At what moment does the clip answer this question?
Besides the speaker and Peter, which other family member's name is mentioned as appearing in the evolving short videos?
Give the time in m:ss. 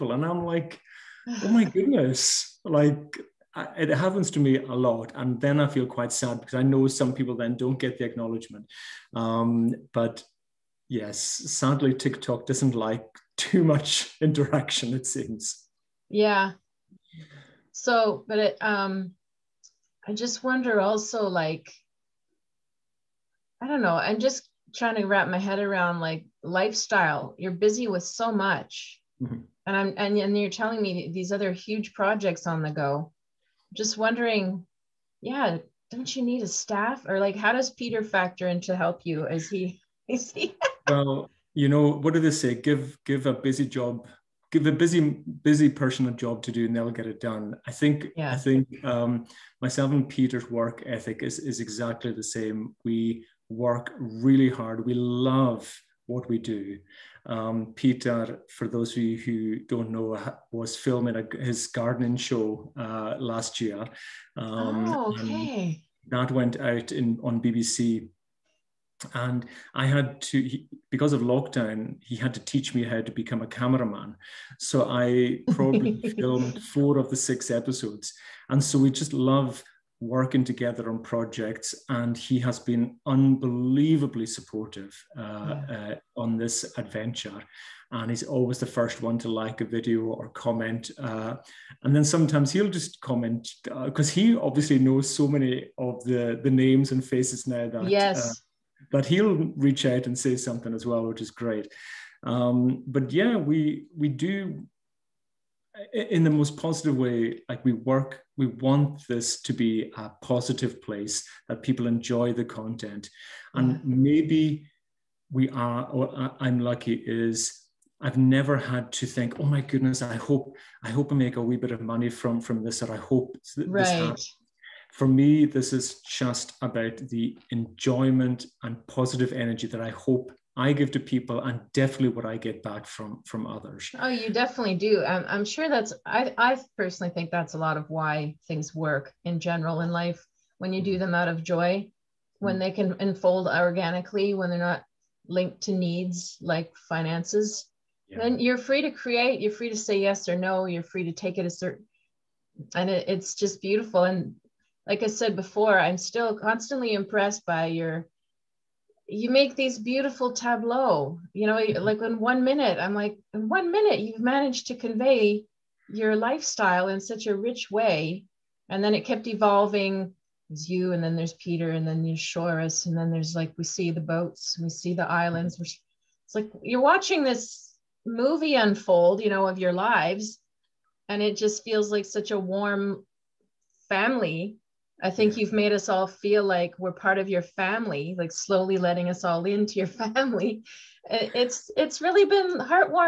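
2:52.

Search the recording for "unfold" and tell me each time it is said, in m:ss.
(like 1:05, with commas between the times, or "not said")
2:22, 2:58.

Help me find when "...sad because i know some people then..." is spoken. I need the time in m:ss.
0:06.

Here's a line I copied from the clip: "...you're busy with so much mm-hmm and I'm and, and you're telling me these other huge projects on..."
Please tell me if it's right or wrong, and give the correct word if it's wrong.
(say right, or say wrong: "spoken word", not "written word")
right.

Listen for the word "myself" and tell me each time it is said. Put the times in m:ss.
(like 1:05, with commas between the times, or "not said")
0:49.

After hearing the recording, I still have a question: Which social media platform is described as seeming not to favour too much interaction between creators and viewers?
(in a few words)
TikTok.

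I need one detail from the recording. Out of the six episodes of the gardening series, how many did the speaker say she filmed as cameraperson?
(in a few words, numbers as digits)
4.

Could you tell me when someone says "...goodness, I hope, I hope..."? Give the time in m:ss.
1:59.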